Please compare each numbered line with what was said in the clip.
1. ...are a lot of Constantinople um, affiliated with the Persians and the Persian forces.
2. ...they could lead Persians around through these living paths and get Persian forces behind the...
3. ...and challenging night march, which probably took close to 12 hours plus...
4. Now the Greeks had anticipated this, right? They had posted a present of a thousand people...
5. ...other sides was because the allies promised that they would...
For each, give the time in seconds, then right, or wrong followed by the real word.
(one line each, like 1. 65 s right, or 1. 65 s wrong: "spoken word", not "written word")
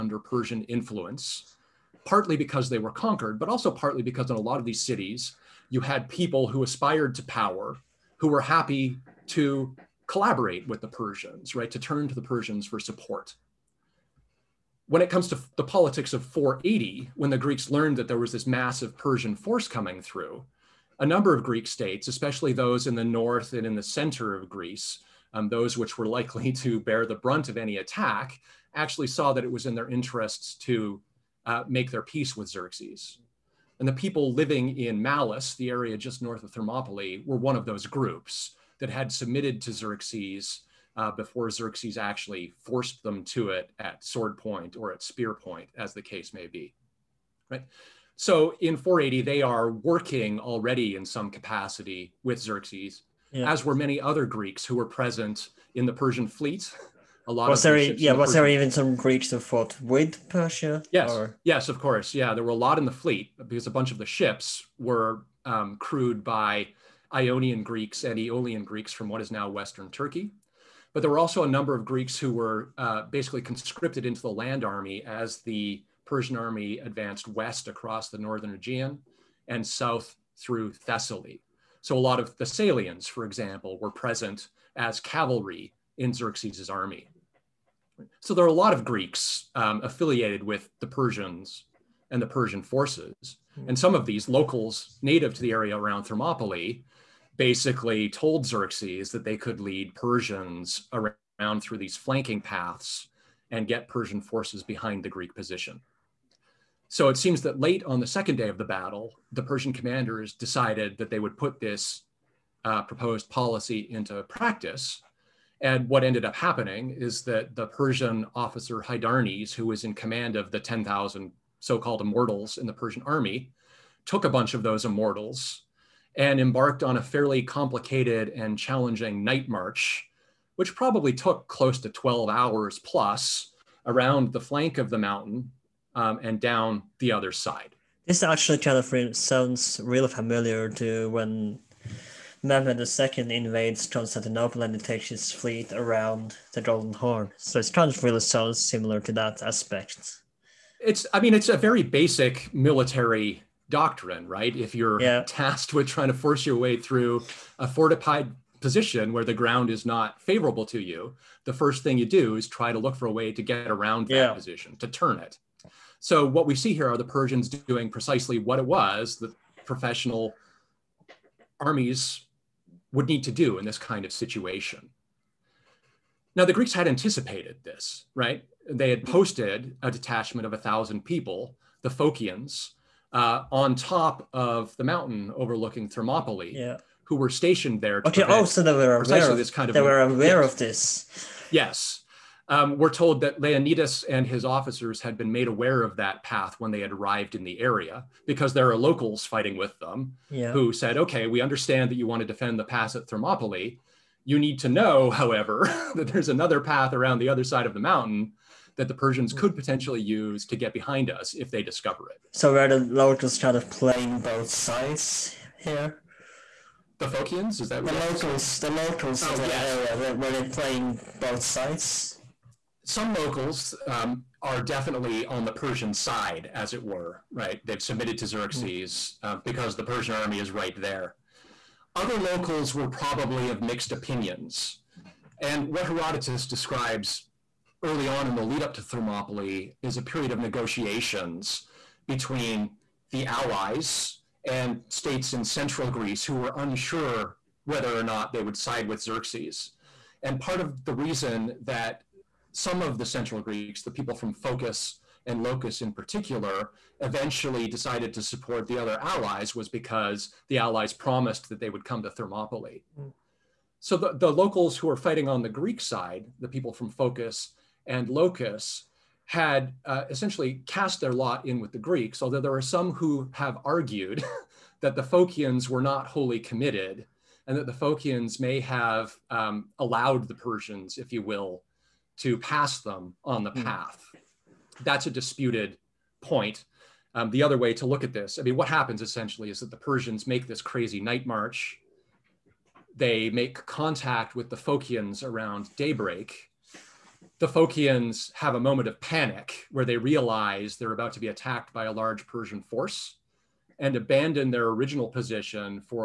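1. 88 s wrong: "Greeks", not "Constantinople"
2. 99 s wrong: "flanking", not "living"
3. 128 s right
4. 176 s wrong: "detachment", not "present"
5. 258 s wrong: "allies", not "sides".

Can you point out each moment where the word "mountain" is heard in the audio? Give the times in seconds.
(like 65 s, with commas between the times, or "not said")
134 s, 184 s, 207 s.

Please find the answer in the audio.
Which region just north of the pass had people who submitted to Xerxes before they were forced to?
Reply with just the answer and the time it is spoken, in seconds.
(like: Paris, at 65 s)
Malis, at 35 s.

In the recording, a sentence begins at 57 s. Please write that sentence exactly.
A lot was of there, yeah, the was Persian there even some Greeks who fought with Persia?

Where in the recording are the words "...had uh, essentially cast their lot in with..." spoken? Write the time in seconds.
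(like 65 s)
269 s.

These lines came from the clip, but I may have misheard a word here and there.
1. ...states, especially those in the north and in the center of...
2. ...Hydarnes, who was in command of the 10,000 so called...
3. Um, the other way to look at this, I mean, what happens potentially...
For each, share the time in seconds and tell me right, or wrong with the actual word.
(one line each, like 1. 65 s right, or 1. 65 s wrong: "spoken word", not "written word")
1. 21 s right
2. 118 s right
3. 287 s wrong: "essentially", not "potentially".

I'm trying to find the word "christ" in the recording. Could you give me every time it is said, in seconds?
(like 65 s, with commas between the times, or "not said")
not said.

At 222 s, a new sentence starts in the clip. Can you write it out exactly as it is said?
Some locals um, are definitely on the Persian side, as it were.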